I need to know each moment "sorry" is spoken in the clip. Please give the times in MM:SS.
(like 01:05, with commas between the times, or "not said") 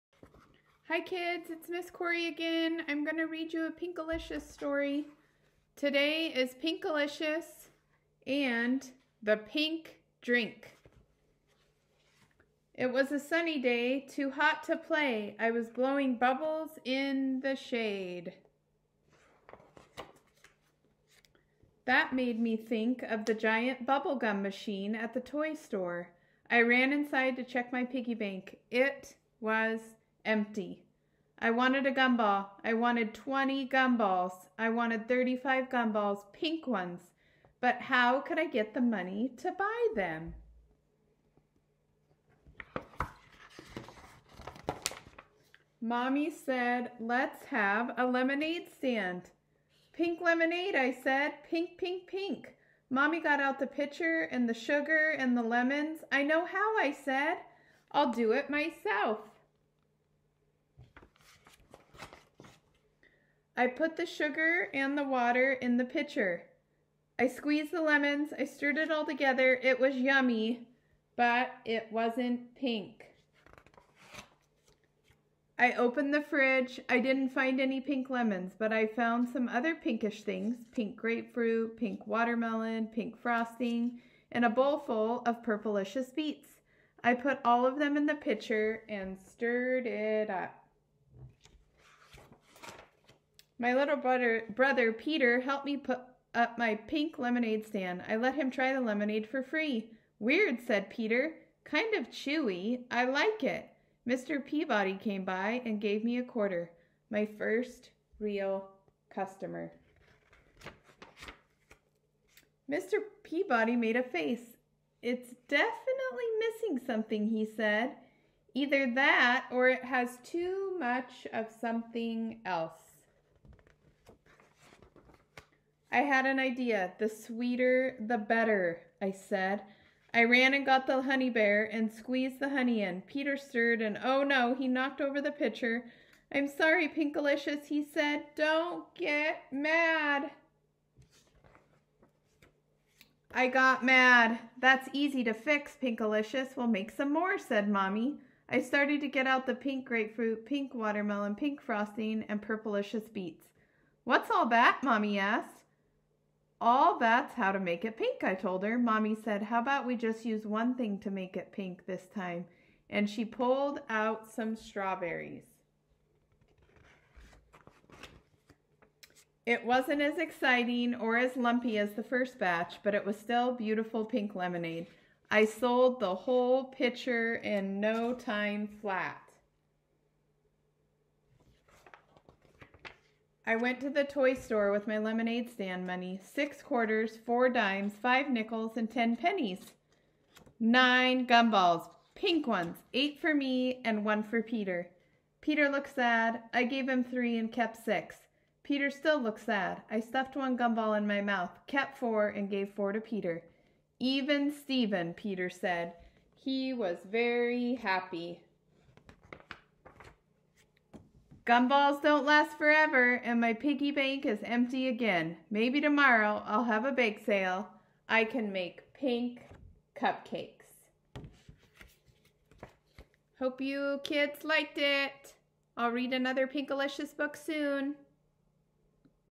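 02:16.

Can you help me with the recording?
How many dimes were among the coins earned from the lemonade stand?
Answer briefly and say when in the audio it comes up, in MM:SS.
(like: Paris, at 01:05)
4, at 03:07.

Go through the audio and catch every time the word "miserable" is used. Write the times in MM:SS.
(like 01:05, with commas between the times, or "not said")
not said.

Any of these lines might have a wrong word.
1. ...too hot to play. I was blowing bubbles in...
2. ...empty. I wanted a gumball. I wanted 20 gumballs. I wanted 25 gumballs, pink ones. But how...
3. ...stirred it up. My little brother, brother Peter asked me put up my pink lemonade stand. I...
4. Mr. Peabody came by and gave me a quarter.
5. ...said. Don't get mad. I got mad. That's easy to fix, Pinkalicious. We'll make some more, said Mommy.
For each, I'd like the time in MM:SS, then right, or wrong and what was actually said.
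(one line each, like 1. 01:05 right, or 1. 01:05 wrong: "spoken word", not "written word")
1. 00:14 right
2. 00:30 wrong: "35", not "25"
3. 01:29 wrong: "helped", not "asked"
4. 01:44 right
5. 02:17 right.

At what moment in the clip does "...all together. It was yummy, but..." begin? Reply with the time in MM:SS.
01:08.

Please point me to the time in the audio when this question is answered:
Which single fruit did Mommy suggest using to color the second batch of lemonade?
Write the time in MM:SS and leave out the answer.
02:44.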